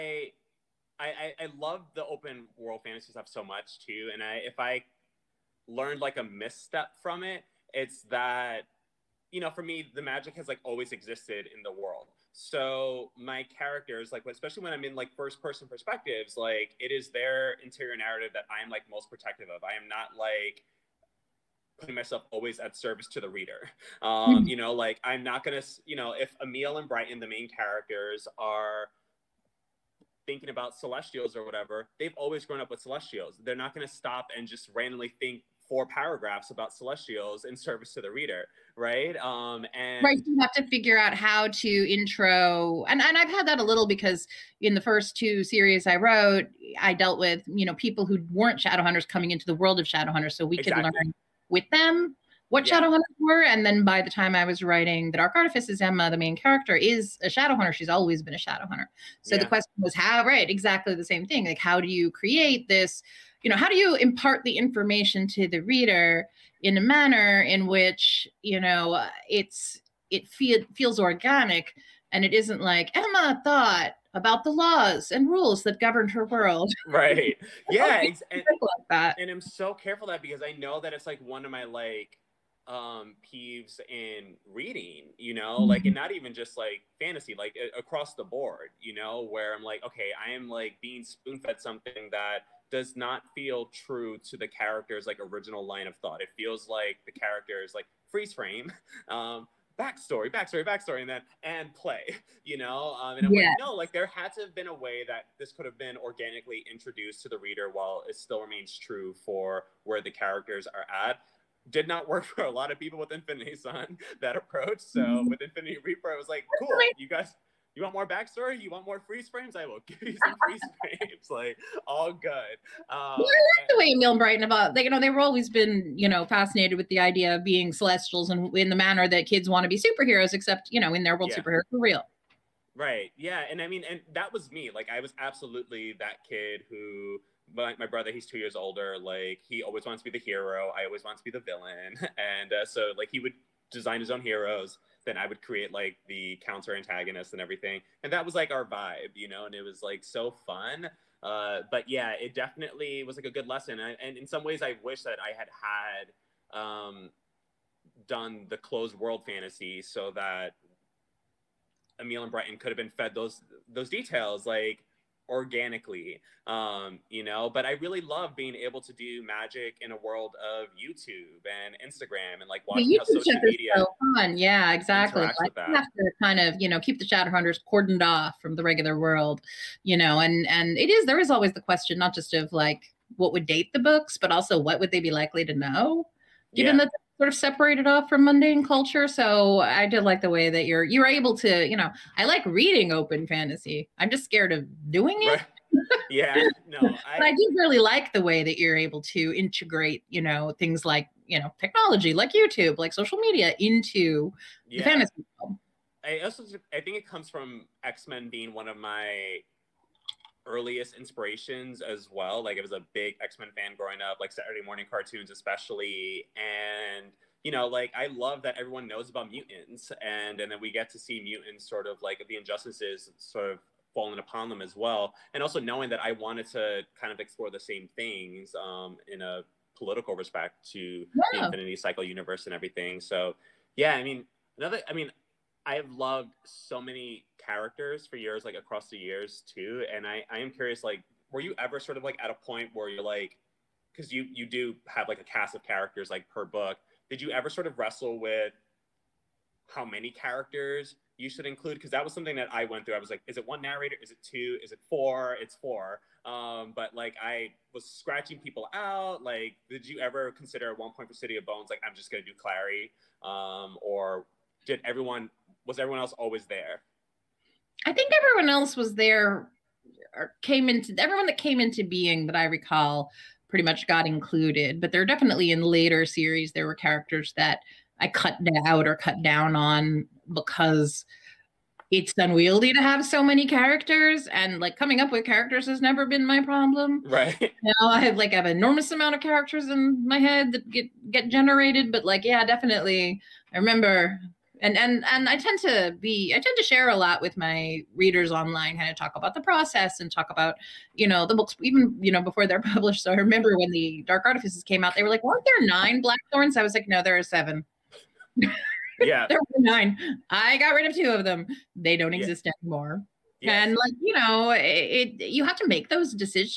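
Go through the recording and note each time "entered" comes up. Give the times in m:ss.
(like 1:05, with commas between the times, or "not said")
not said.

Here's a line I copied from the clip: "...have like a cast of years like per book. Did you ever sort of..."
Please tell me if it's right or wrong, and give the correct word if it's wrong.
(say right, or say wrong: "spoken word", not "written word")
wrong: "characters", not "years".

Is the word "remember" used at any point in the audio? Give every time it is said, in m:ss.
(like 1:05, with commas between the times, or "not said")
4:53, 5:03.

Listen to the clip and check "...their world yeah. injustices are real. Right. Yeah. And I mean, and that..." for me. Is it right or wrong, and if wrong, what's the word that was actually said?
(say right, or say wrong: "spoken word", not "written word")
wrong: "superheroes", not "injustices".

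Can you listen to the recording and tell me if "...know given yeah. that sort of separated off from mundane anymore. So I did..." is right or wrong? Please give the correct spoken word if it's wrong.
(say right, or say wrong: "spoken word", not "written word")
wrong: "culture", not "anymore".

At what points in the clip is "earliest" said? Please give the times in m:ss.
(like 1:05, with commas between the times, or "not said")
3:30.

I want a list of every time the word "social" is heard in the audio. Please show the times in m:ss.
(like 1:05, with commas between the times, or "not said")
2:53, 3:22.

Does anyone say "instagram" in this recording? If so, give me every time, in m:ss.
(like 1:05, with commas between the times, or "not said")
2:51.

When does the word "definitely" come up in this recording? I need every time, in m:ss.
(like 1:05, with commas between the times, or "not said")
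2:32, 4:35, 4:52.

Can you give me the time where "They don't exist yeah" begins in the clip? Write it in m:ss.
5:11.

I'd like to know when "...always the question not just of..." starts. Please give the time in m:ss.
3:01.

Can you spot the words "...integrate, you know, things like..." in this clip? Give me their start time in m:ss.
3:19.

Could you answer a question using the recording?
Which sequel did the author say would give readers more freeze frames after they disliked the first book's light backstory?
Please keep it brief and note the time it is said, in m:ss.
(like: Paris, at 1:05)
Infinity Reaper, at 1:55.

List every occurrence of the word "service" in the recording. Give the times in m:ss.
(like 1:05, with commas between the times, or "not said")
0:22, 0:37.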